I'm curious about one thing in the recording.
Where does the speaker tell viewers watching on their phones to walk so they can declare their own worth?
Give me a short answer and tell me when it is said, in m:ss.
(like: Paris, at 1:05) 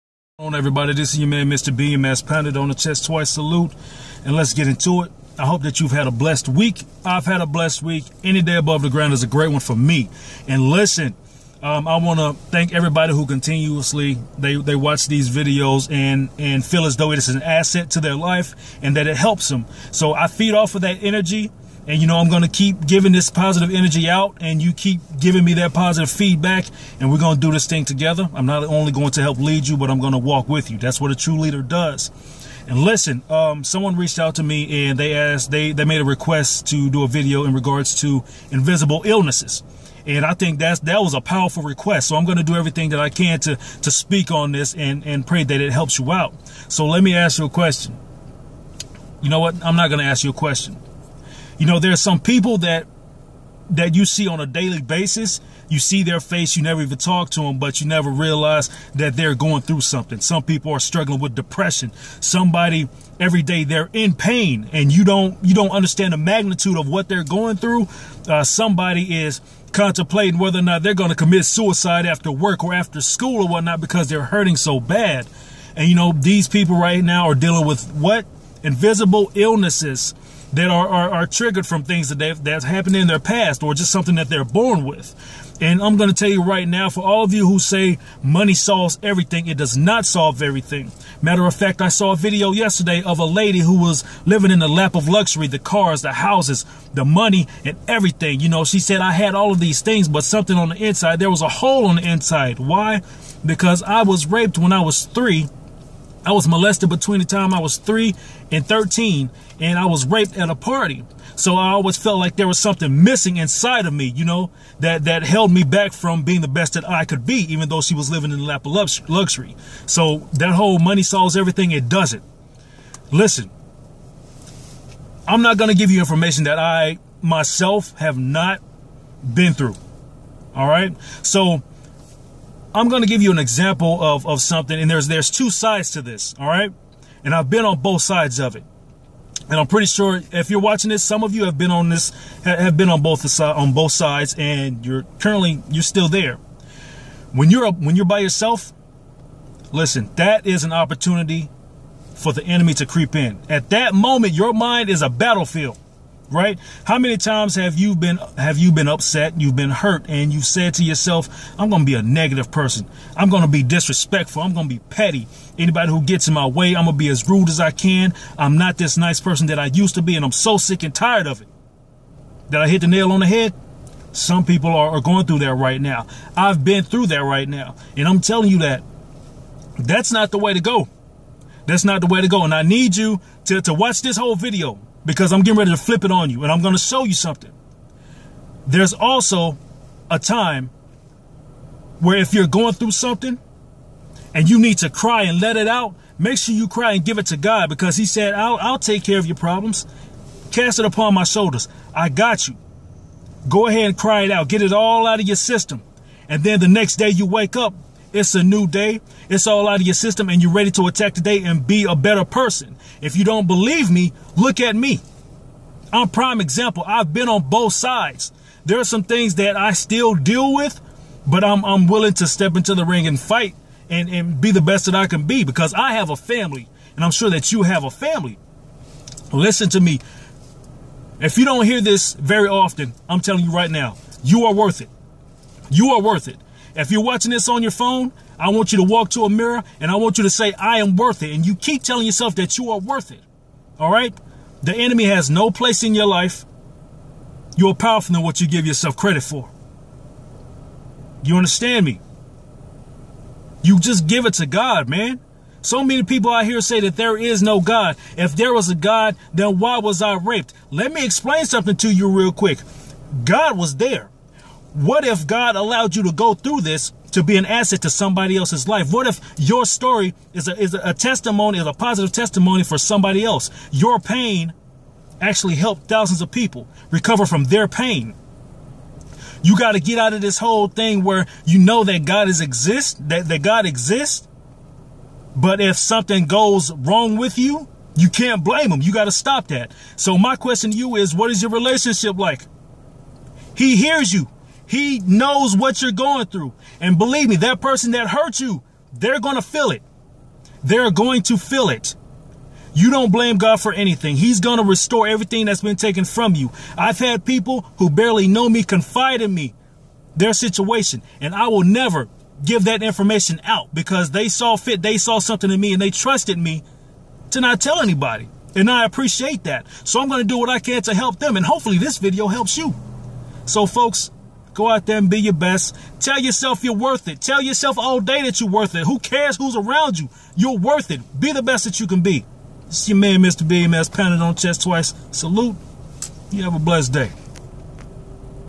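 To a mirror, at 3:59.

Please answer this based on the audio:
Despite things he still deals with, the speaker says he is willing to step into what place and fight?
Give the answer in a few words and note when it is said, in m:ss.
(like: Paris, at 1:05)
The ring, at 3:42.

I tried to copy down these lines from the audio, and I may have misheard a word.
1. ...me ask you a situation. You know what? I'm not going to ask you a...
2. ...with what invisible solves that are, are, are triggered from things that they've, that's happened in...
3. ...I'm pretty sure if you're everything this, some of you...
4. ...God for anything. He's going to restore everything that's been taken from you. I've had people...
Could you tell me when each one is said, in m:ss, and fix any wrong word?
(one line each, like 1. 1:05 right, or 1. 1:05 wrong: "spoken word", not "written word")
1. 0:47 wrong: "question", not "situation"
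2. 1:17 wrong: "illnesses", not "solves"
3. 2:19 wrong: "watching", not "everything"
4. 5:03 right.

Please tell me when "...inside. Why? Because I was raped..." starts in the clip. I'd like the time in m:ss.
1:42.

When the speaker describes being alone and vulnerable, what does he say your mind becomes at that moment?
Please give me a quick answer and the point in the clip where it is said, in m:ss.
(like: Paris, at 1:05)
A battlefield, at 2:35.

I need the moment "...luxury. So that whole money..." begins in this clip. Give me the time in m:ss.
1:59.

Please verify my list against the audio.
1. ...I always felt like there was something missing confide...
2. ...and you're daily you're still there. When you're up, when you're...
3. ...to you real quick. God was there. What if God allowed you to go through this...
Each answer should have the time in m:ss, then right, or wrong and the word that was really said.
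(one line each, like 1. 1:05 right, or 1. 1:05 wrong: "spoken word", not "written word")
1. 1:51 wrong: "inside", not "confide"
2. 2:24 wrong: "currently", not "daily"
3. 4:21 right.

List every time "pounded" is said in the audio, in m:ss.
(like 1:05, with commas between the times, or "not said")
0:02, 5:33.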